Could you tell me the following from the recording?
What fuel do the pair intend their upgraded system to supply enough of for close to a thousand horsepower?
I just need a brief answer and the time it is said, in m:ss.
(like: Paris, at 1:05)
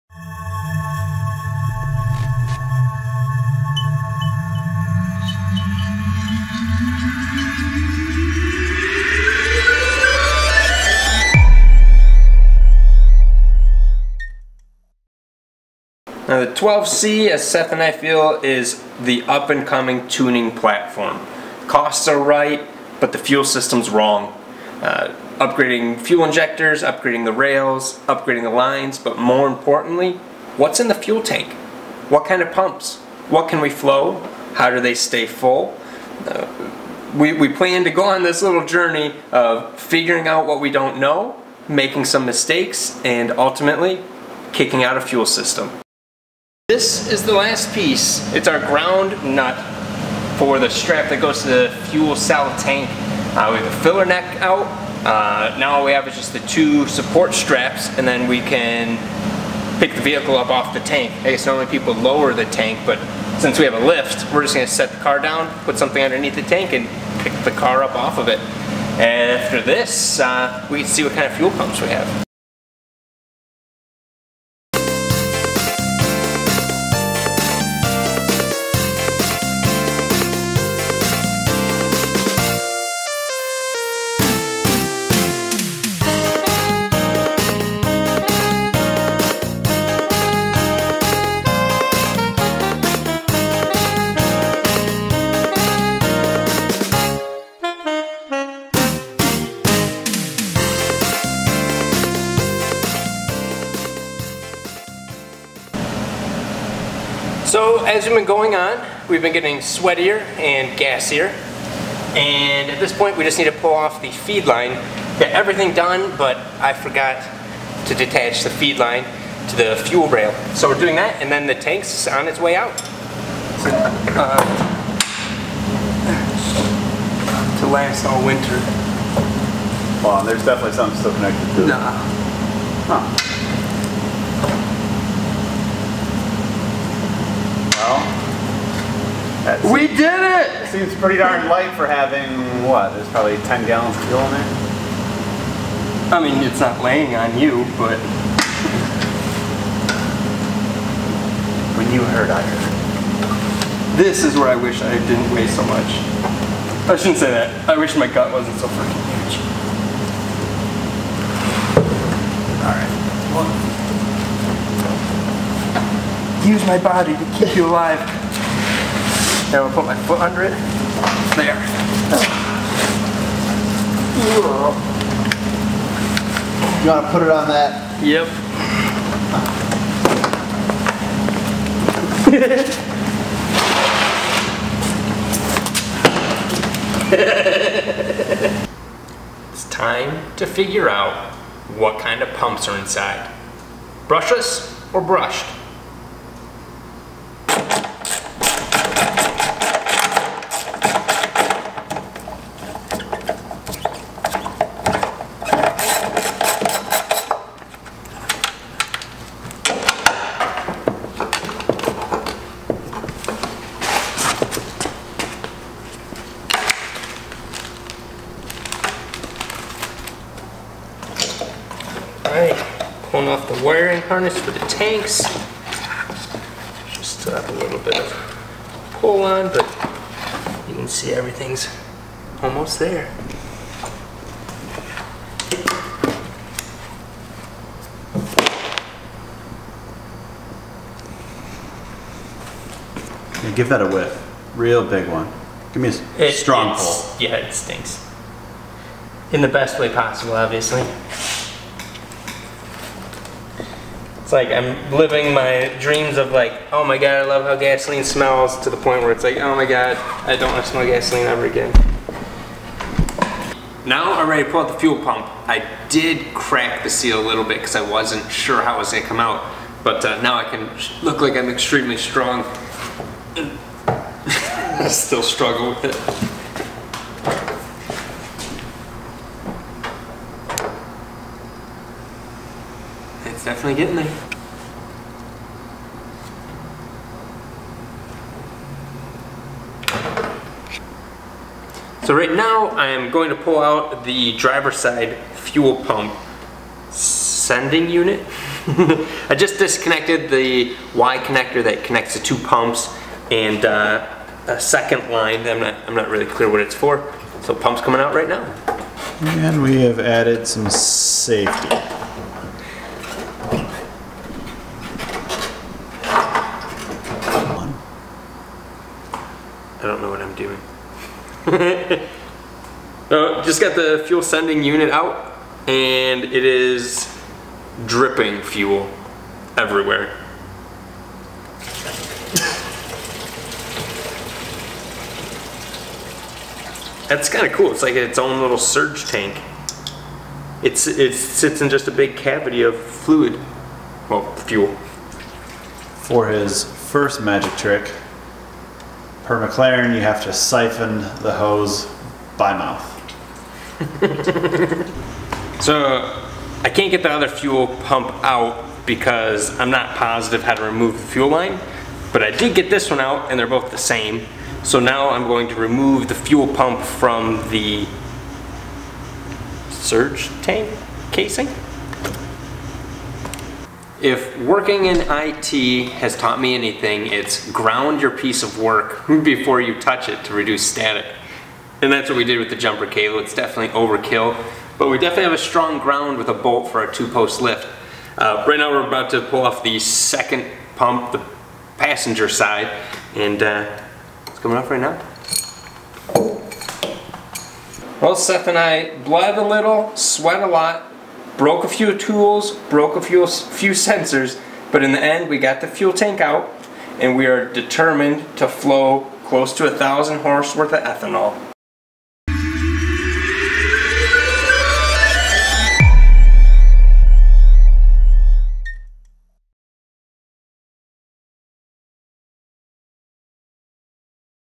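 Ethanol, at 6:50.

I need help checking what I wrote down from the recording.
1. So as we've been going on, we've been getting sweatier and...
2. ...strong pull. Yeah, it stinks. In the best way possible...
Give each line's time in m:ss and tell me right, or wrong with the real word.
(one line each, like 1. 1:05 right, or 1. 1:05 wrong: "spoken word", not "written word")
1. 1:47 right
2. 4:06 right.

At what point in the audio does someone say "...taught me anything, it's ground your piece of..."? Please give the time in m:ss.
6:16.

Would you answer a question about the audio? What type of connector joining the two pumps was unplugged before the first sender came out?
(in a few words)
Y connector.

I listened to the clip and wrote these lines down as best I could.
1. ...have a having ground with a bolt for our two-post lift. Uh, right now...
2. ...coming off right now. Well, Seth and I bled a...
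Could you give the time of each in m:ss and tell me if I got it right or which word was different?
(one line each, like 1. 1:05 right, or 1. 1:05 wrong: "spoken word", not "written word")
1. 6:25 wrong: "strong", not "having"
2. 6:34 right.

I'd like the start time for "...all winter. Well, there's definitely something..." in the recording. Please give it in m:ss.
2:08.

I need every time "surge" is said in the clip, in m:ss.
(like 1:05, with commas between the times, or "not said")
5:38, 6:09.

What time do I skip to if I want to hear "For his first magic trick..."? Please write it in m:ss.
5:46.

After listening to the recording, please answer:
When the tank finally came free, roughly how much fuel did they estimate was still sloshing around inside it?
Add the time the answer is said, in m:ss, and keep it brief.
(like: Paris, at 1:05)
10 gallons, at 2:23.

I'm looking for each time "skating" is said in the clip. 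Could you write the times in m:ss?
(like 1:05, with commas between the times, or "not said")
not said.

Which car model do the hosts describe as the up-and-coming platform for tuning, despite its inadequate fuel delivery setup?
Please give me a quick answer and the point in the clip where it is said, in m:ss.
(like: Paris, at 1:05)
12C, at 0:16.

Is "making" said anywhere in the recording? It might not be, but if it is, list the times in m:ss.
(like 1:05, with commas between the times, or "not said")
0:41.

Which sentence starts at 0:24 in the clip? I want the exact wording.
Uh, upgrading fuel injectors, upgrading the rails, upgrading the lines, but more importantly, what's in the fuel tank?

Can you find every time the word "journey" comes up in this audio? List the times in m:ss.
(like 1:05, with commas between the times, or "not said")
0:38.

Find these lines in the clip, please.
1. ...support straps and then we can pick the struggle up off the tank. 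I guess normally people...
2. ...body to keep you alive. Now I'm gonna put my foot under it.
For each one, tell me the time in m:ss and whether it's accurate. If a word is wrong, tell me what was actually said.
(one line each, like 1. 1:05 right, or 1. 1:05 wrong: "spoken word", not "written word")
1. 0:56 wrong: "vehicle", not "struggle"
2. 2:46 right.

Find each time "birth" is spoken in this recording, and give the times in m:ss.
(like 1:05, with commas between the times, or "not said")
not said.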